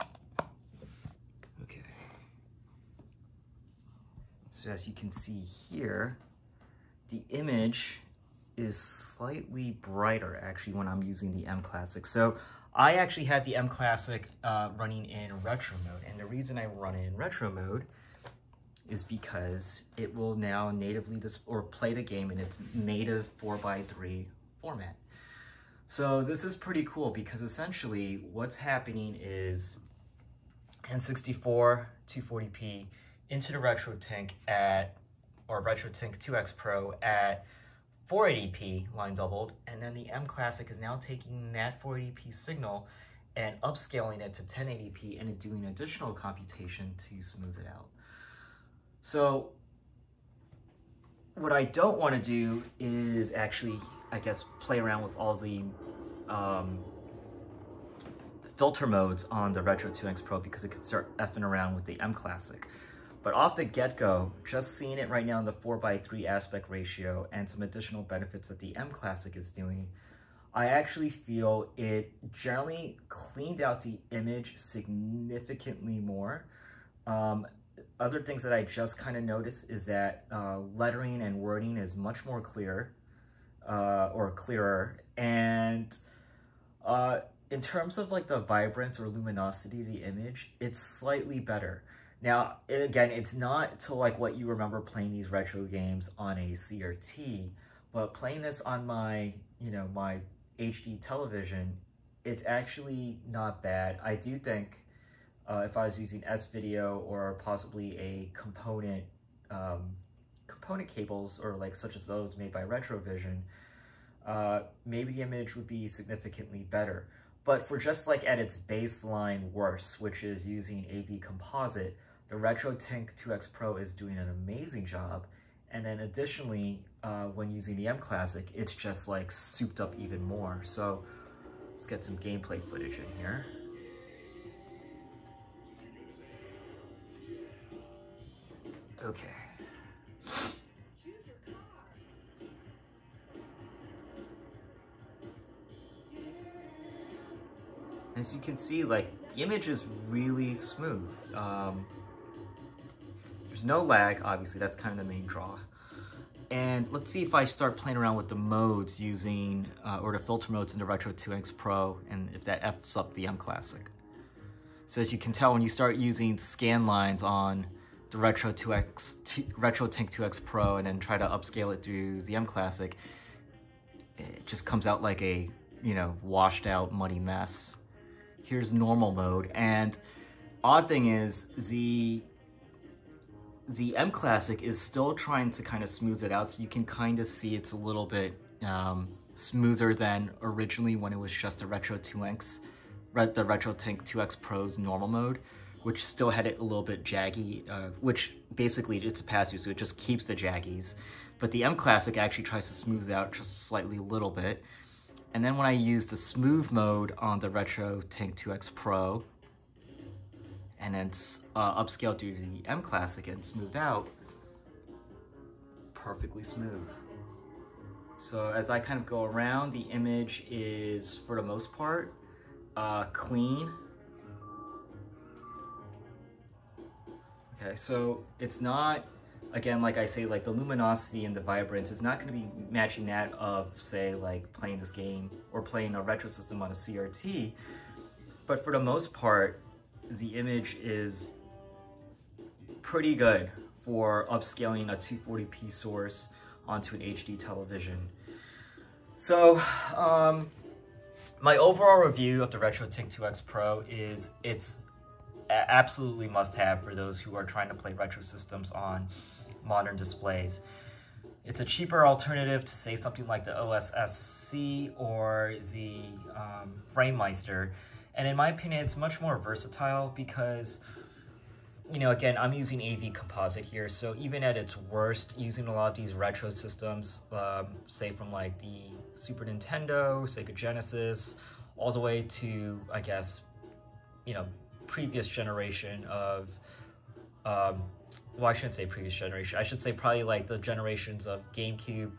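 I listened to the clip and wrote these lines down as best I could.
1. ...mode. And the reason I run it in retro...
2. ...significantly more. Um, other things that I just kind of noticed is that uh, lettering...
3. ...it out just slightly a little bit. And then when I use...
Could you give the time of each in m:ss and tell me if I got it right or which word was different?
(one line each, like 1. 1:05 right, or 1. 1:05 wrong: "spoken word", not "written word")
1. 0:15 right
2. 1:14 right
3. 3:23 right.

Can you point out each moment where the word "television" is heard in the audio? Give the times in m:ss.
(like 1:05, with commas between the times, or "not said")
1:40, 4:07.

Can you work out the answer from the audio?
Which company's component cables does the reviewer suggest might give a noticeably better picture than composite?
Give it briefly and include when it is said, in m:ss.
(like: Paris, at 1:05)
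Retrovision, at 1:52.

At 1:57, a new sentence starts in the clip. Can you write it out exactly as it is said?
But for just like at its baseline worse, which is using AV Composite, the RetroTINK 2X Pro is doing an amazing job.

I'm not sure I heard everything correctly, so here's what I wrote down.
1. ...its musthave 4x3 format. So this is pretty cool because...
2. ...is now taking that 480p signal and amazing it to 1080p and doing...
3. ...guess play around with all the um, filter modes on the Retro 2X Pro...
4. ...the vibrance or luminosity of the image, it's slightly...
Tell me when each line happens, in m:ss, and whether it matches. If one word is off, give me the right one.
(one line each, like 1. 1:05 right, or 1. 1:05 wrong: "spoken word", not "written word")
1. 0:22 wrong: "native", not "musthave"
2. 0:40 wrong: "upscaling", not "amazing"
3. 0:54 right
4. 1:28 right.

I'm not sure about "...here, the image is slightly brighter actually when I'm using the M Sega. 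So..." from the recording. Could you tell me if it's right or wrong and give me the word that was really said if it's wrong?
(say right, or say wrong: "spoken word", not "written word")
wrong: "Classic", not "Sega".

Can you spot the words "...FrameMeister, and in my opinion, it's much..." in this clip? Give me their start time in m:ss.
4:26.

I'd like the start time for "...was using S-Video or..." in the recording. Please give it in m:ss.
1:45.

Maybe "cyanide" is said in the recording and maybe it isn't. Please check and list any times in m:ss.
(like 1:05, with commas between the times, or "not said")
not said.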